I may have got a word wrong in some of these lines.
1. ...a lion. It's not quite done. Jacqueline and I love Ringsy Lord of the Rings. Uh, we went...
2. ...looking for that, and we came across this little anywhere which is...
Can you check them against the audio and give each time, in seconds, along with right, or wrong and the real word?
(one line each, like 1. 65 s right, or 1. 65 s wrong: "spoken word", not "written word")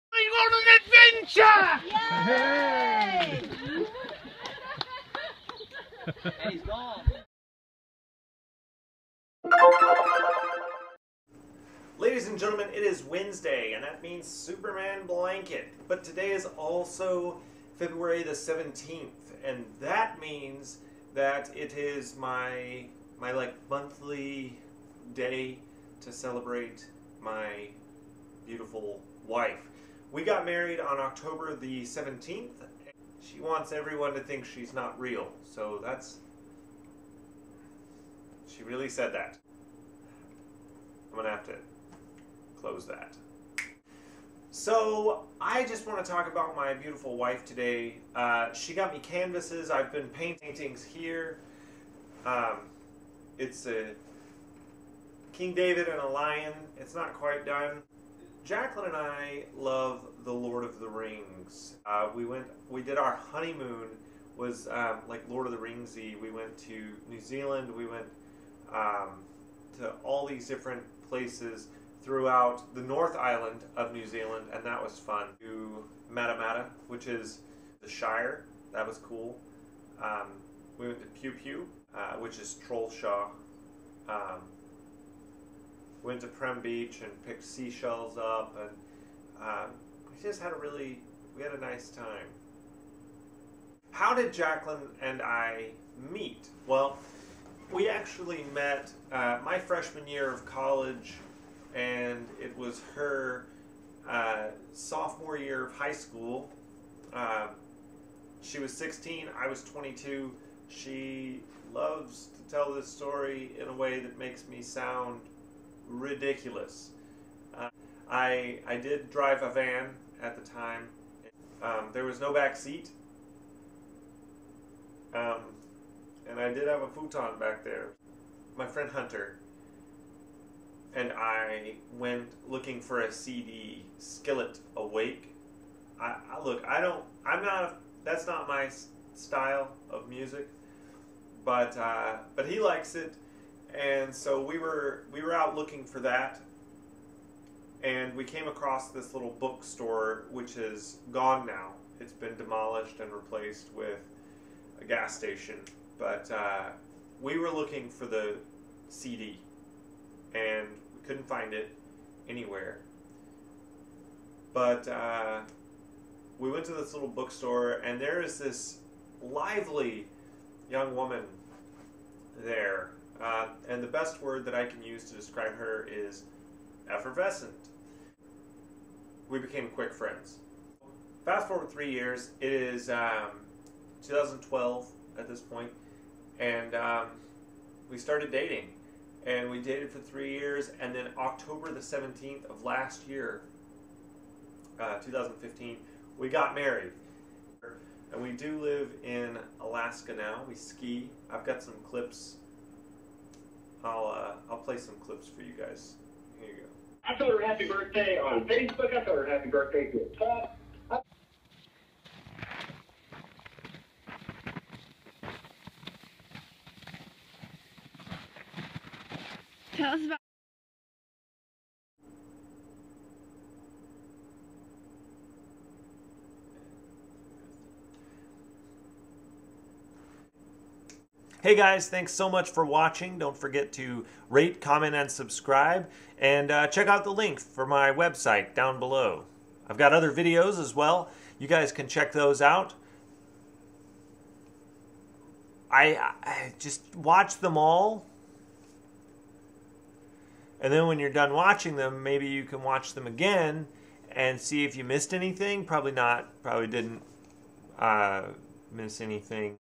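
1. 56 s wrong: "The", not "Ringsy"
2. 145 s wrong: "bookstore", not "anywhere".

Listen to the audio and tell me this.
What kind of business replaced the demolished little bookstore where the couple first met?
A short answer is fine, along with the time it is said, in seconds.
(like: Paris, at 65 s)
gas station, at 154 s.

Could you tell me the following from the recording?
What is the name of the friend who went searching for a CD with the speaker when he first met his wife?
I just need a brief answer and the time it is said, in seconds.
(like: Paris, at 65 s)
Hunter, at 128 s.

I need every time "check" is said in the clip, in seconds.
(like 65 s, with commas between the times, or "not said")
236 s, 241 s.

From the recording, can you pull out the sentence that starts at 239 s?
I've got other videos as well.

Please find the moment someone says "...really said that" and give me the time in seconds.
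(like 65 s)
38 s.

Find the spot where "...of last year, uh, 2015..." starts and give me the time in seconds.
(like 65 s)
192 s.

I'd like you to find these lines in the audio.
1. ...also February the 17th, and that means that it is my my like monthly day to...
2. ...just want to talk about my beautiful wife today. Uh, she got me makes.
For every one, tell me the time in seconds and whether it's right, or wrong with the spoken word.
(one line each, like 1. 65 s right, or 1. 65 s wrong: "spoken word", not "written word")
1. 16 s right
2. 45 s wrong: "canvases", not "makes".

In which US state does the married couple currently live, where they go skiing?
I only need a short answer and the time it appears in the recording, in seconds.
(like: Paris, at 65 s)
Alaska, at 199 s.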